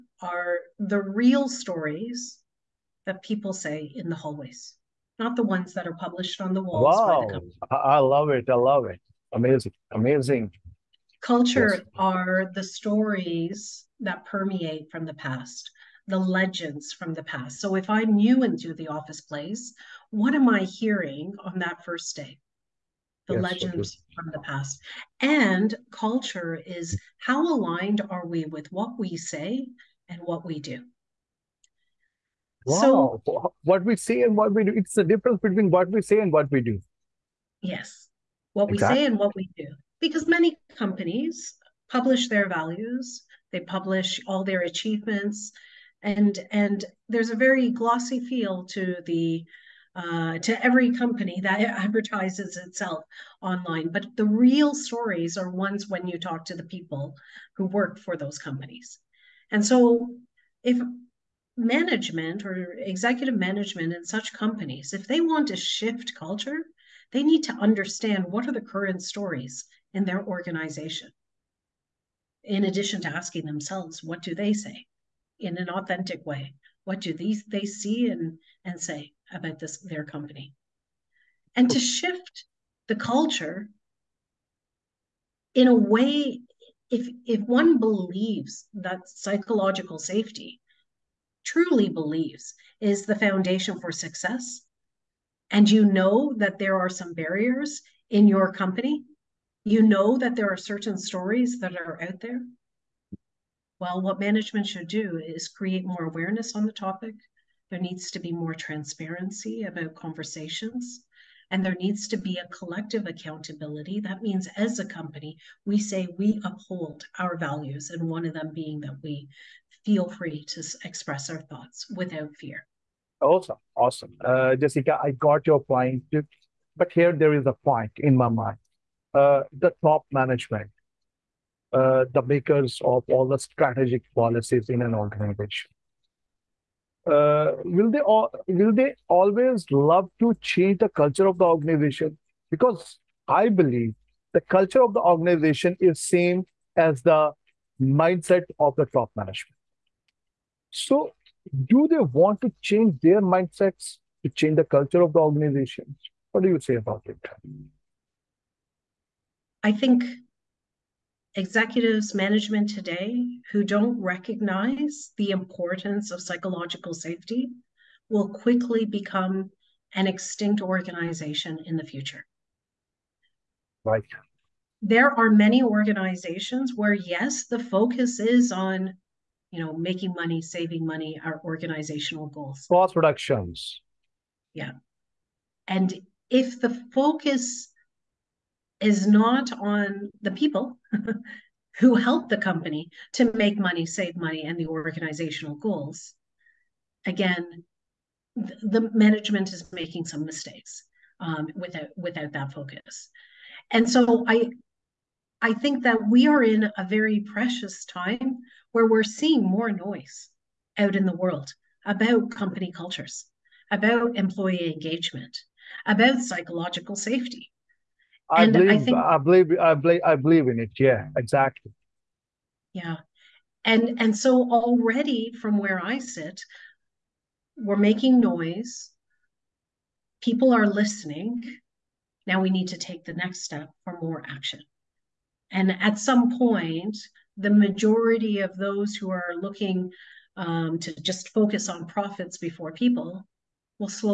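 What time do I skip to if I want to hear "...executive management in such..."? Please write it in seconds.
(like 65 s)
62 s.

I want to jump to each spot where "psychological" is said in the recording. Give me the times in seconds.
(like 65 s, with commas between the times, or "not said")
89 s, 166 s, 216 s.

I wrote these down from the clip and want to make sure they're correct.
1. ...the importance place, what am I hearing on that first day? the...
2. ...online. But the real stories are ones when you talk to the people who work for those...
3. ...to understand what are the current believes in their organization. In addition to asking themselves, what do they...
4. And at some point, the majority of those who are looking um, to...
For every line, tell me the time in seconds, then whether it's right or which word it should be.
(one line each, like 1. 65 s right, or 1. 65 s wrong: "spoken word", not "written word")
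1. 18 s wrong: "office", not "importance"
2. 53 s right
3. 67 s wrong: "stories", not "believes"
4. 235 s right.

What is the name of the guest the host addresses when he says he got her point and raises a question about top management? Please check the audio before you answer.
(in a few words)
Jessica.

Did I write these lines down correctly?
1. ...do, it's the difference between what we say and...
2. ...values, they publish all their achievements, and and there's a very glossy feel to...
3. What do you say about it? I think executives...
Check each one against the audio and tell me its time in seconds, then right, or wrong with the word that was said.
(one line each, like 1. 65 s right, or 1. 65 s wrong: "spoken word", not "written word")
1. 34 s right
2. 42 s right
3. 156 s right.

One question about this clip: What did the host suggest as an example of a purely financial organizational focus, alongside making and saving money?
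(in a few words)
Cost reductions.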